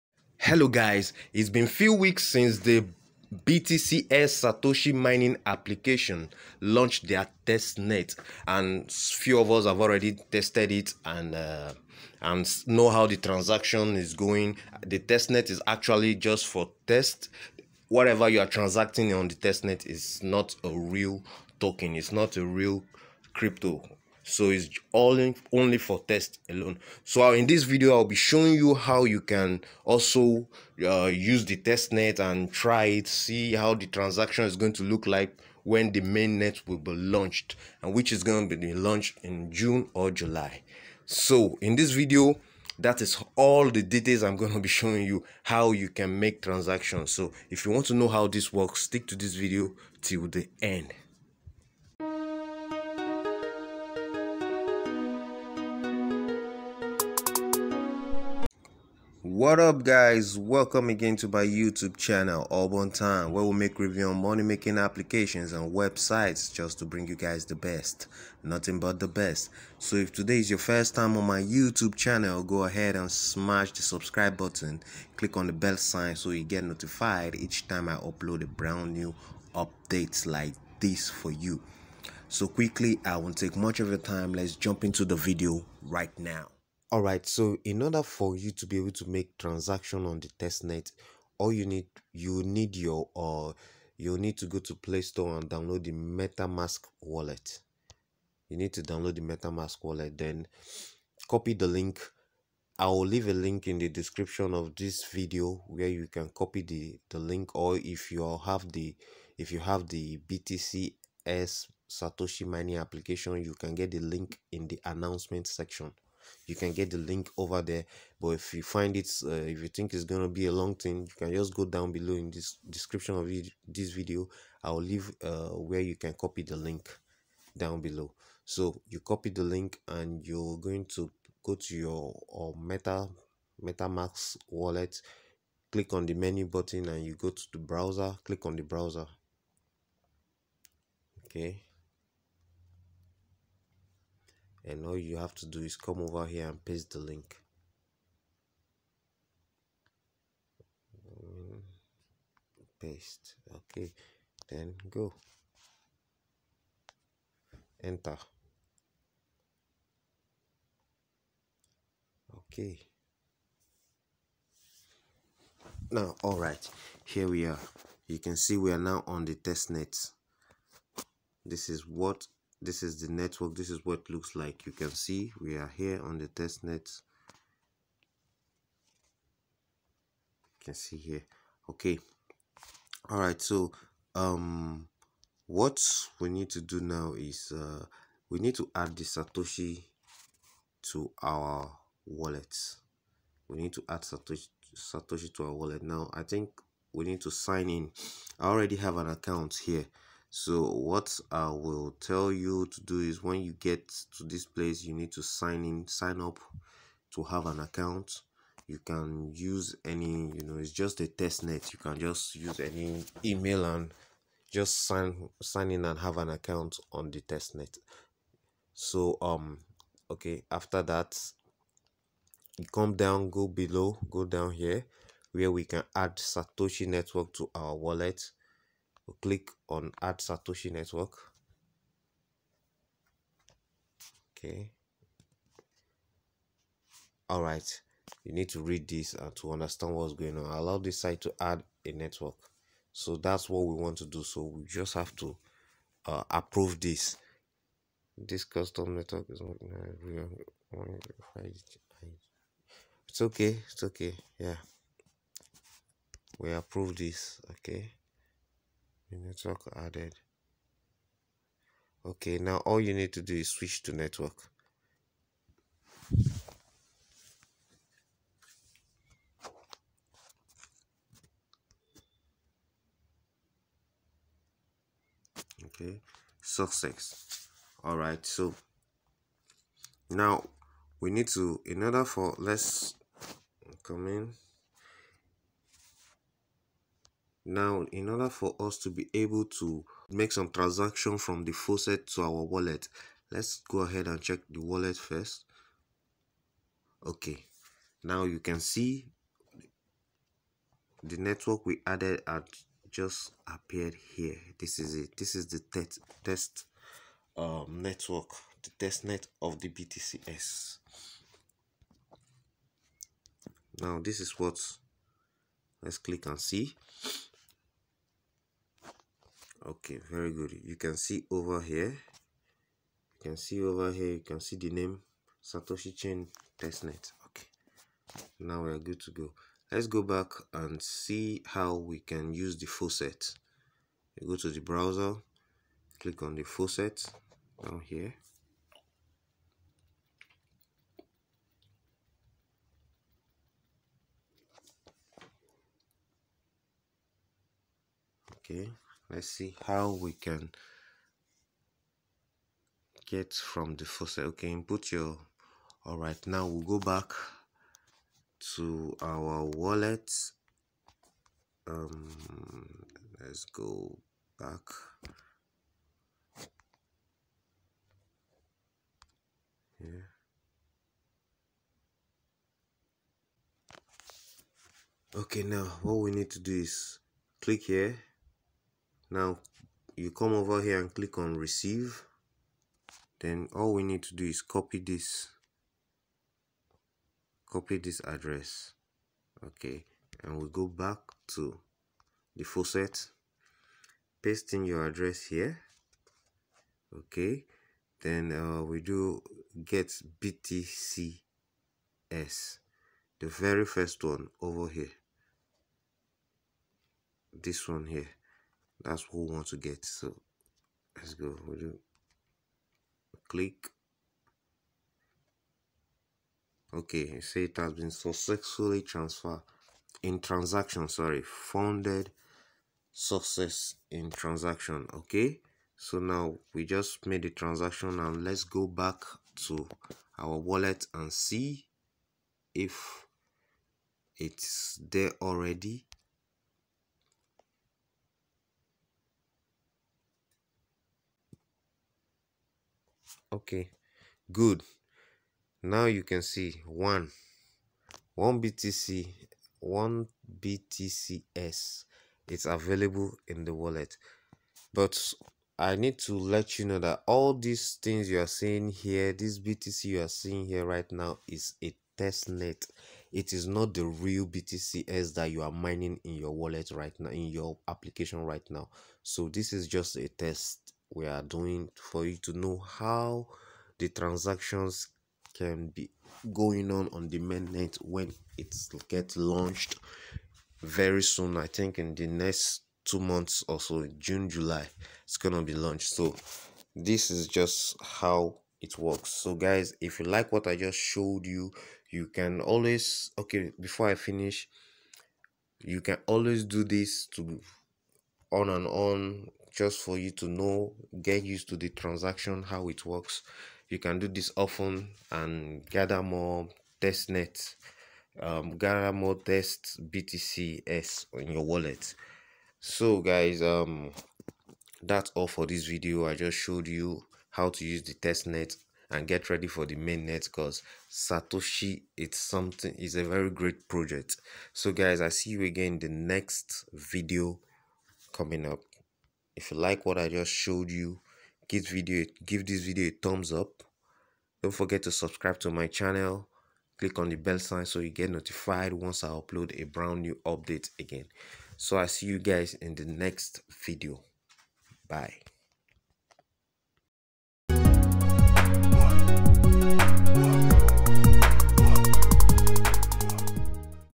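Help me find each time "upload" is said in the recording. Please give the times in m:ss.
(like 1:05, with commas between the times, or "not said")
1:17, 8:59.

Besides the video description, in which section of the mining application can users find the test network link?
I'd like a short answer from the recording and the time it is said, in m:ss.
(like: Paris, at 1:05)
announcement section, at 1:54.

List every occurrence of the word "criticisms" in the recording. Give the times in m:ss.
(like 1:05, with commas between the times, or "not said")
not said.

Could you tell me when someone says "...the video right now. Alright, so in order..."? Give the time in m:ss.
1:25.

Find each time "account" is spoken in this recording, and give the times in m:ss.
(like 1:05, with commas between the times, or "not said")
3:19, 3:27, 3:36.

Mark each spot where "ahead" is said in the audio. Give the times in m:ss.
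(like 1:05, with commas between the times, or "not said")
1:12, 4:53.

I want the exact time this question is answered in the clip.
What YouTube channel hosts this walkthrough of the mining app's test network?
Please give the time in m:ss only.
1:02.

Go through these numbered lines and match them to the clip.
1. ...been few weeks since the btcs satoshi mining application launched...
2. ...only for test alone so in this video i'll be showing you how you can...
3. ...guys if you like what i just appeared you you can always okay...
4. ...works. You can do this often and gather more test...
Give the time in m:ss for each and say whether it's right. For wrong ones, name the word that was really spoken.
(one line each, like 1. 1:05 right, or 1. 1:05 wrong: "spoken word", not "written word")
1. 0:01 right
2. 0:25 right
3. 8:09 wrong: "showed", not "appeared"
4. 8:22 right.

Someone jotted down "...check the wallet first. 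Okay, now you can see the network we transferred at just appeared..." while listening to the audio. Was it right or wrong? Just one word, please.
wrong.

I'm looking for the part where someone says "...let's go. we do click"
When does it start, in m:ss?
6:50.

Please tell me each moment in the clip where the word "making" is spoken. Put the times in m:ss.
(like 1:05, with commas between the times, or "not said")
1:04.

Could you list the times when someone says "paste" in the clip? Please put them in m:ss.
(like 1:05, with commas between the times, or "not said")
2:26, 2:32, 6:34.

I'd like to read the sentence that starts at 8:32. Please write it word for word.
So guys, um, that's all for this video.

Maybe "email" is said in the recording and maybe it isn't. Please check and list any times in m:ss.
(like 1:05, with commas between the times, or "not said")
3:33.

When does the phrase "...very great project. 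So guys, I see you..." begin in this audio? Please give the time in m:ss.
8:43.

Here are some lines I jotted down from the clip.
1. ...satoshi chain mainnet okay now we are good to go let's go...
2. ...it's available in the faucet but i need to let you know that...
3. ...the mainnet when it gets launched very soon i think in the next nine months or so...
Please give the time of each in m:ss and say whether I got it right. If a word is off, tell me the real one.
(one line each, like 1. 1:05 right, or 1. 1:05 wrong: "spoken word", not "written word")
1. 5:25 wrong: "testnet", not "mainnet"
2. 7:32 wrong: "wallet", not "faucet"
3. 7:57 wrong: "two", not "nine".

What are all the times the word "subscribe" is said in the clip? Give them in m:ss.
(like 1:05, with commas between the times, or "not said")
1:13, 8:54.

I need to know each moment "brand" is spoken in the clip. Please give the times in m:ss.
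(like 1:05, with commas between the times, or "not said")
1:18, 8:59.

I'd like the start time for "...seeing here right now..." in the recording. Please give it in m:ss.
7:40.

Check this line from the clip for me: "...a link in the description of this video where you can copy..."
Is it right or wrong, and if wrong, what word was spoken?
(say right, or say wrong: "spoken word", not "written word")
right.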